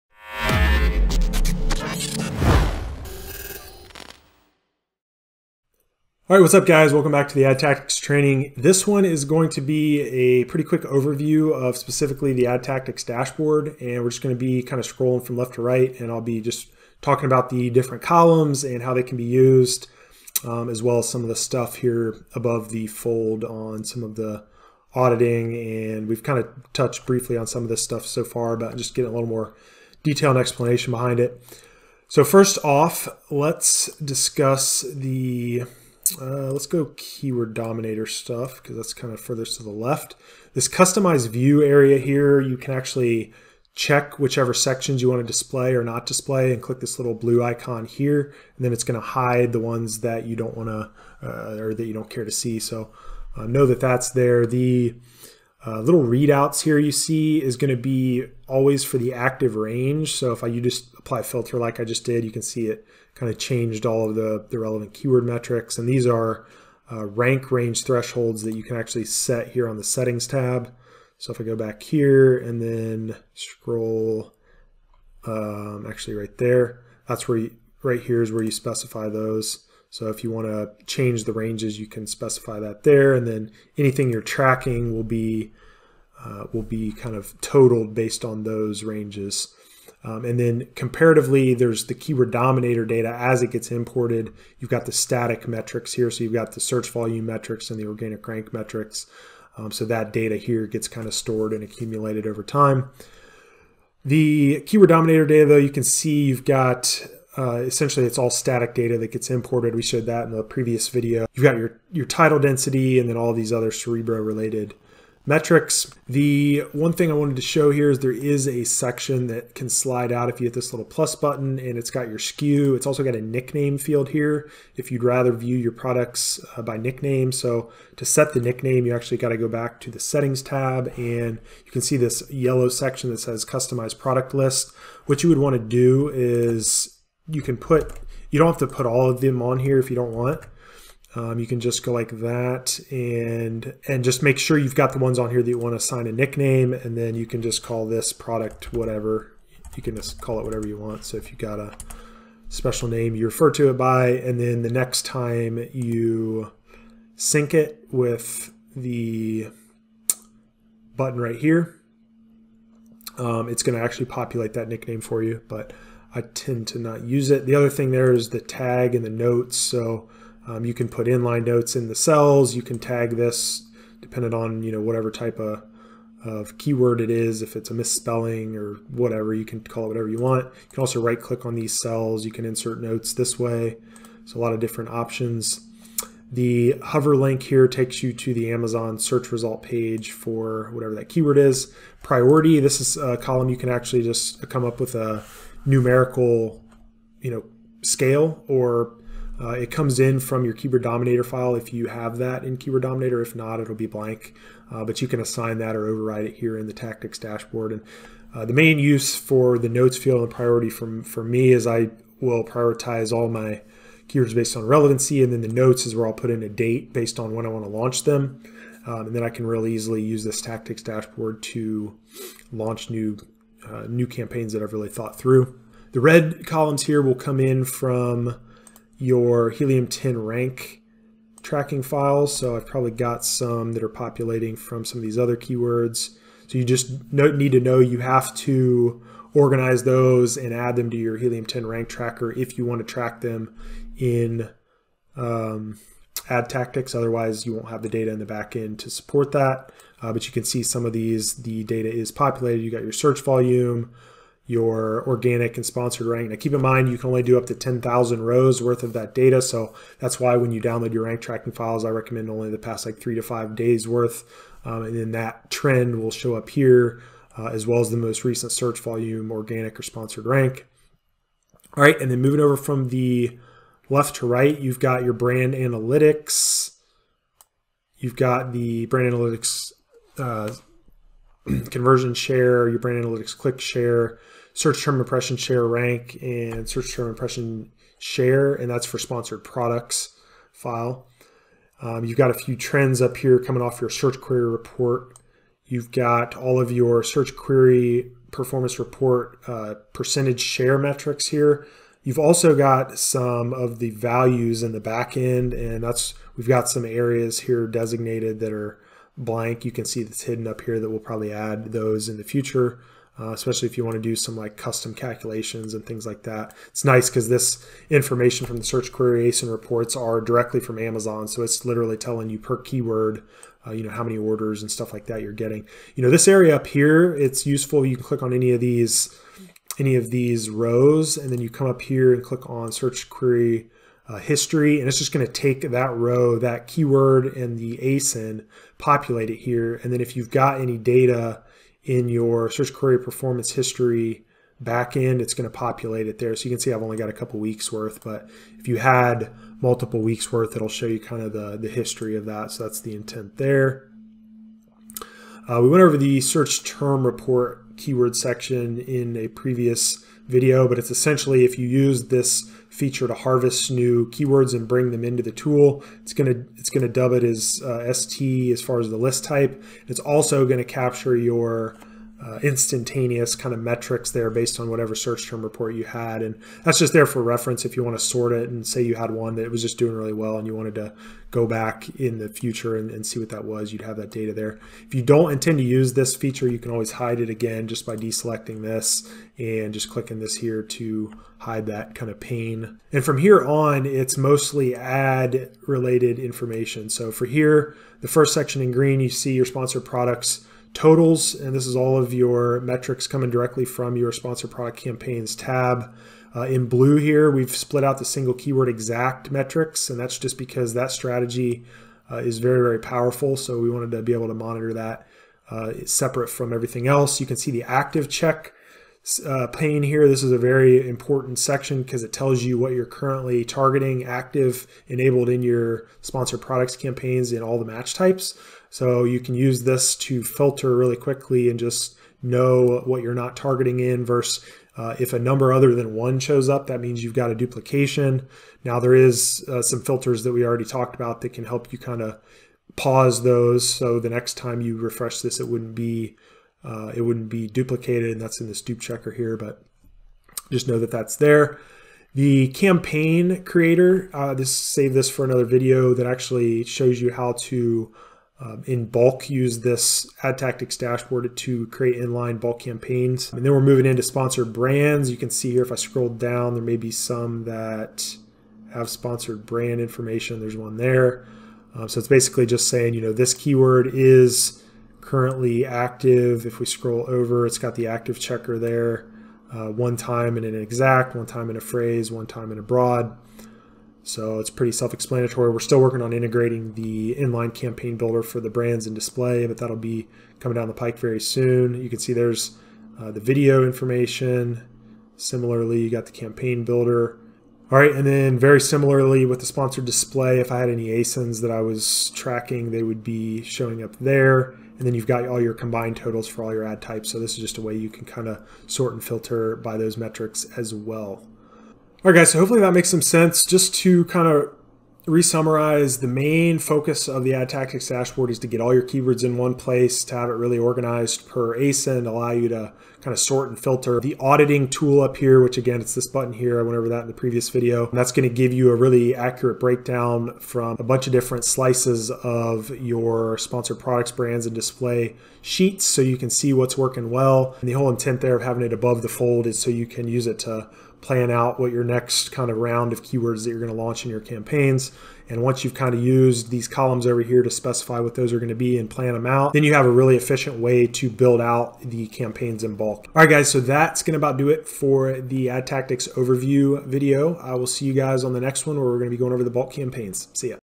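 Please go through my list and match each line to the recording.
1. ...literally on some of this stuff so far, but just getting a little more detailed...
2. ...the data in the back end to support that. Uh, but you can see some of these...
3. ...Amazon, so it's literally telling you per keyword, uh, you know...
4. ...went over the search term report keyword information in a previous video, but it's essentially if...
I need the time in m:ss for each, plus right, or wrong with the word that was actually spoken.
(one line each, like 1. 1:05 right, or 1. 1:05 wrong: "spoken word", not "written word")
1. 0:27 wrong: "briefly", not "literally"
2. 4:07 right
3. 5:20 right
4. 5:55 wrong: "section", not "information".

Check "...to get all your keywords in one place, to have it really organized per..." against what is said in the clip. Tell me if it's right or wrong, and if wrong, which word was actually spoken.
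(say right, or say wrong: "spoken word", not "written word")
right.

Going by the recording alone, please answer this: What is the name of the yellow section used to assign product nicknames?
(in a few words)
customize product list.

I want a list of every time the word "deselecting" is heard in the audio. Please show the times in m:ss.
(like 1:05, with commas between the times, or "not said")
6:27.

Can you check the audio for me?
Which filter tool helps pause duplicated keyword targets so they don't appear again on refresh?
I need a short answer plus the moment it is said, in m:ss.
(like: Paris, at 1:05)
dupe checker, at 7:28.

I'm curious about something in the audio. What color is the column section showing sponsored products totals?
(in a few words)
green.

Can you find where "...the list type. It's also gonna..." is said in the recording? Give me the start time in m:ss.
6:08.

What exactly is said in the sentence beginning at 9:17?
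I will see you guys on the next one where we're going to be going over the bulk campaigns.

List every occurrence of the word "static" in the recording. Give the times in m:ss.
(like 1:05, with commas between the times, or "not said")
1:34, 1:48.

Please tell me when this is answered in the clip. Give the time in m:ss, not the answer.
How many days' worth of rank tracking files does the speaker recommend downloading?
4:22.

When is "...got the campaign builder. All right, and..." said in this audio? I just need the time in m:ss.
8:15.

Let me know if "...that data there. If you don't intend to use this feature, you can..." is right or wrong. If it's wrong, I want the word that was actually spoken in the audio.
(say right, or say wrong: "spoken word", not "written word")
right.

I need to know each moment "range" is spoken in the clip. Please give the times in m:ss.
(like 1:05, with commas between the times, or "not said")
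0:59, 1:07, 1:21, 1:28.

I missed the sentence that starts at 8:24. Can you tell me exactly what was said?
And then you've got all your combined totals for all your ad types.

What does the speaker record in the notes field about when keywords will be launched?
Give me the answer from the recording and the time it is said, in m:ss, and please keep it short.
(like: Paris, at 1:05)
a date, at 3:36.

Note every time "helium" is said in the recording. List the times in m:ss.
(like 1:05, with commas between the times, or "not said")
3:49, 4:01.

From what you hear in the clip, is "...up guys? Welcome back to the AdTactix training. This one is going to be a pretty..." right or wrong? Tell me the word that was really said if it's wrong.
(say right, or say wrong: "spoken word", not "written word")
right.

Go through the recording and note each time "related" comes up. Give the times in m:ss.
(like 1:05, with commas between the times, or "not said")
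1:54, 6:35.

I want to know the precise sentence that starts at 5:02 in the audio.
You've also got some of the values in the back end, and that's we've got some areas here designated that are blank.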